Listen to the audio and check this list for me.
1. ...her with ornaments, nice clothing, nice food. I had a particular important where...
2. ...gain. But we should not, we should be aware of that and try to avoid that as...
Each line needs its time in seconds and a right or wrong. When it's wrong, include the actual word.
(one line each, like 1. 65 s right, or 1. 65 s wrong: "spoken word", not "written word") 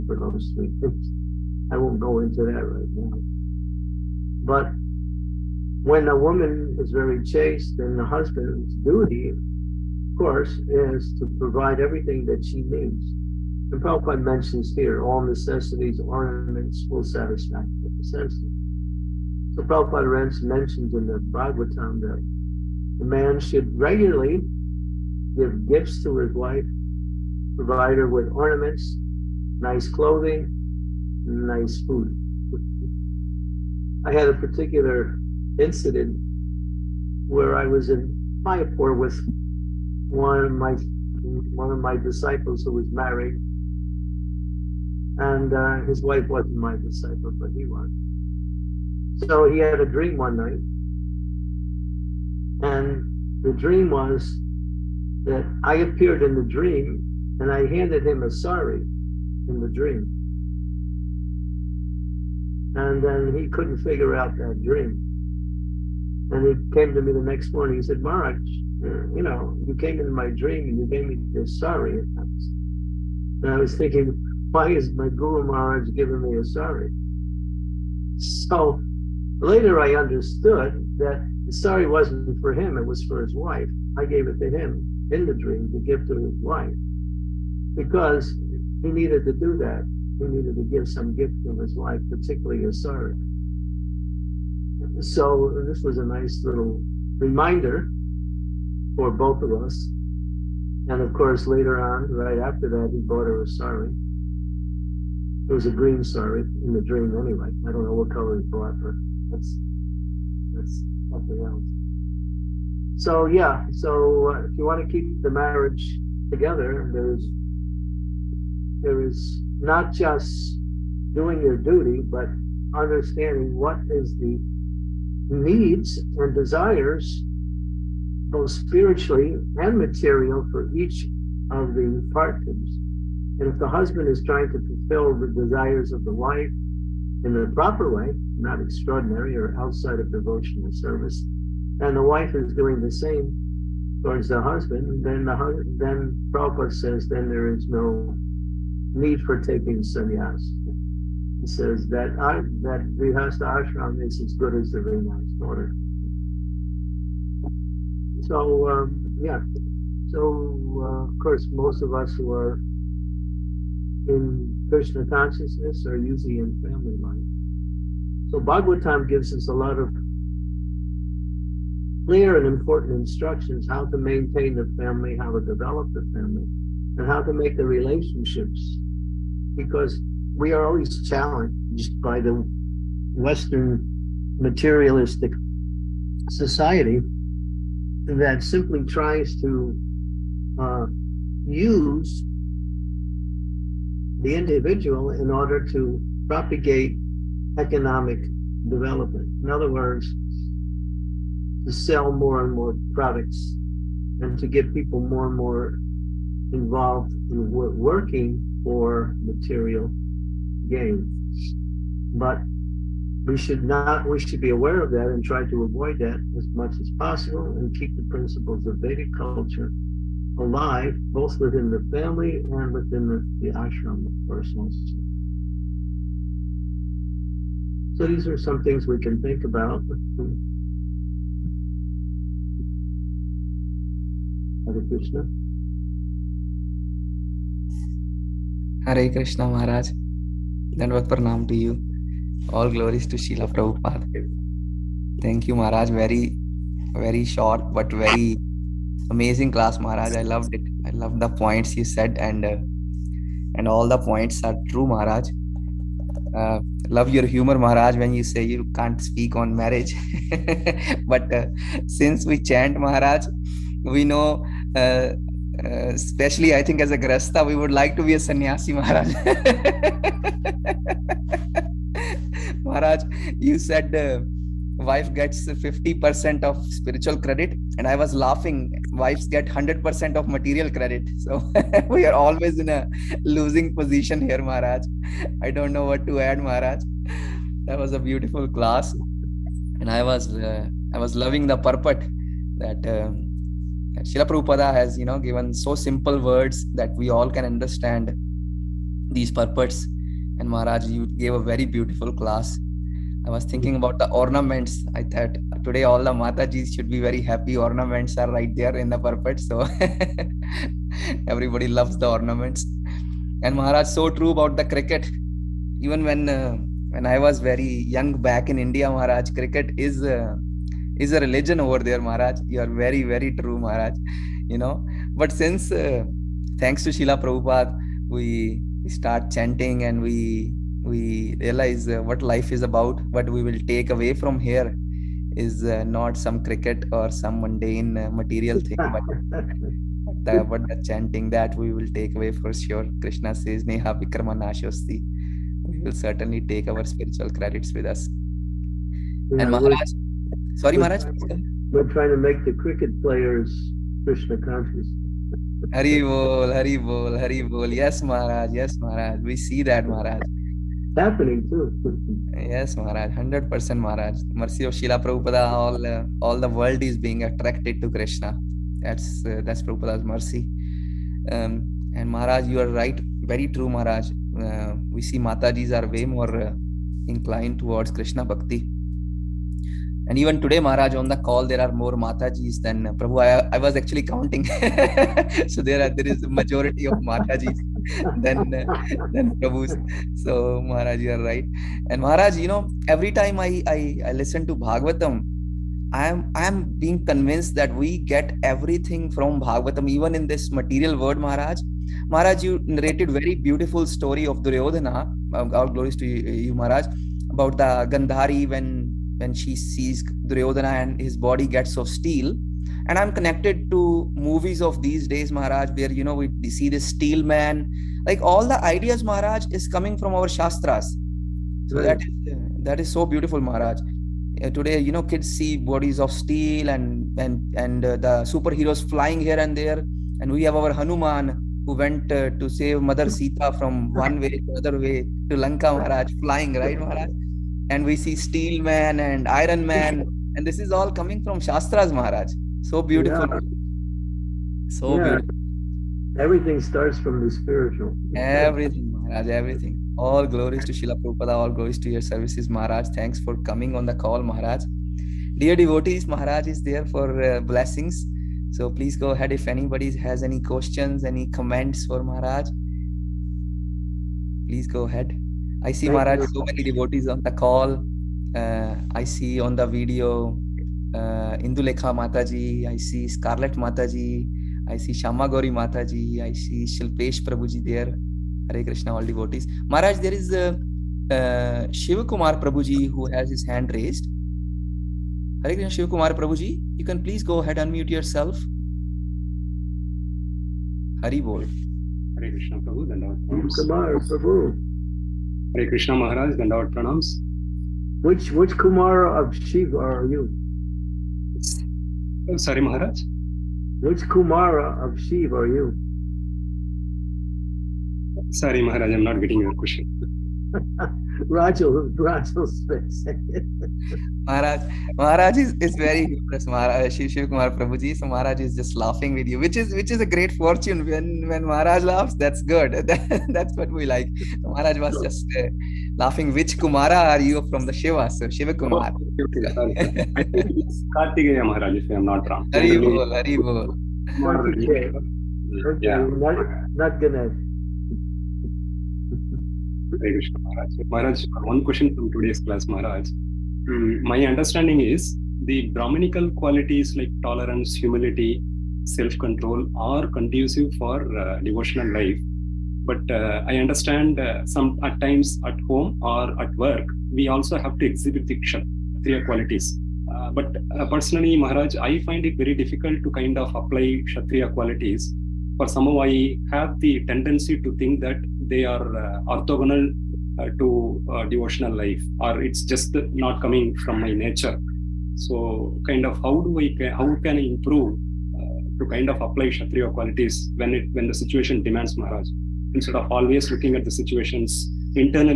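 1. 27 s wrong: "incident", not "important"
2. 210 s right.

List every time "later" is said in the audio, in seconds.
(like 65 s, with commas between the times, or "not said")
79 s, 101 s.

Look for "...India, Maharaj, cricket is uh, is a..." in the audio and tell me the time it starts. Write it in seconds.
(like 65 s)
318 s.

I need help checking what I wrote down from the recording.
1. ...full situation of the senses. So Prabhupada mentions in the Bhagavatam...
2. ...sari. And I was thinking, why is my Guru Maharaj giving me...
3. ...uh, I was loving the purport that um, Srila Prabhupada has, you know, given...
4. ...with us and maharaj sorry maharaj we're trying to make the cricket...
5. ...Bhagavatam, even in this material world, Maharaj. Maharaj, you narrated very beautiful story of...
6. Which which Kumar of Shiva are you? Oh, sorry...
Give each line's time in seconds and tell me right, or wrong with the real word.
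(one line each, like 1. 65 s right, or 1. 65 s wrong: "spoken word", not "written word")
1. 16 s wrong: "satisfaction", not "situation"
2. 71 s right
3. 290 s right
4. 347 s right
5. 399 s right
6. 498 s right.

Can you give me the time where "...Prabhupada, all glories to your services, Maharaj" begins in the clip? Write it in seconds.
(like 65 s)
451 s.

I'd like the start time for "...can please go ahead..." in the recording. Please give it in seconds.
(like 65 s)
486 s.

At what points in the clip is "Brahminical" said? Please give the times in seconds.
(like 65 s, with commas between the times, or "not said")
545 s.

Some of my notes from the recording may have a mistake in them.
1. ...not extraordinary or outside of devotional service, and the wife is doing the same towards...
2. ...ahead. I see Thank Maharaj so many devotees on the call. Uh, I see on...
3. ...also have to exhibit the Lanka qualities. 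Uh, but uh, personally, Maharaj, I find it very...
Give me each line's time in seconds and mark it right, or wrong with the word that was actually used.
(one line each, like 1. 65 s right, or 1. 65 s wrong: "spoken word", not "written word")
1. 138 s right
2. 464 s right
3. 557 s wrong: "Kshatriya", not "Lanka".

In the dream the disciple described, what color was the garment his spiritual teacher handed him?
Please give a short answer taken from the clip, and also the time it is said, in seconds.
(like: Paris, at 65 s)
Green, at 105 s.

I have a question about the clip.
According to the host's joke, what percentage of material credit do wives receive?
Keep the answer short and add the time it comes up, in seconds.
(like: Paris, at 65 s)
100%, at 279 s.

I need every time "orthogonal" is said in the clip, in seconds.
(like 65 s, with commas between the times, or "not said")
569 s.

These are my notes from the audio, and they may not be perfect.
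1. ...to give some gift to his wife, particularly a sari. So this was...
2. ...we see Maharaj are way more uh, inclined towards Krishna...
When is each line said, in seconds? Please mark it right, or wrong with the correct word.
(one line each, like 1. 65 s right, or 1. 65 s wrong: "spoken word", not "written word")
1. 90 s right
2. 374 s wrong: "Matajis", not "Maharaj".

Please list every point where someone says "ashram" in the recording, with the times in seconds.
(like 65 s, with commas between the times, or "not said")
153 s, 223 s.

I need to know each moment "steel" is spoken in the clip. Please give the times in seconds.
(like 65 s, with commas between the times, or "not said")
411 s, 416 s, 426 s, 438 s.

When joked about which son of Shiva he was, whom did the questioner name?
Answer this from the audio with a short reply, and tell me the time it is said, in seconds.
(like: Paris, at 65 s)
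Kartikeya, at 530 s.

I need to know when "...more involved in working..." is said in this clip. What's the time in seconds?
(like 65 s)
205 s.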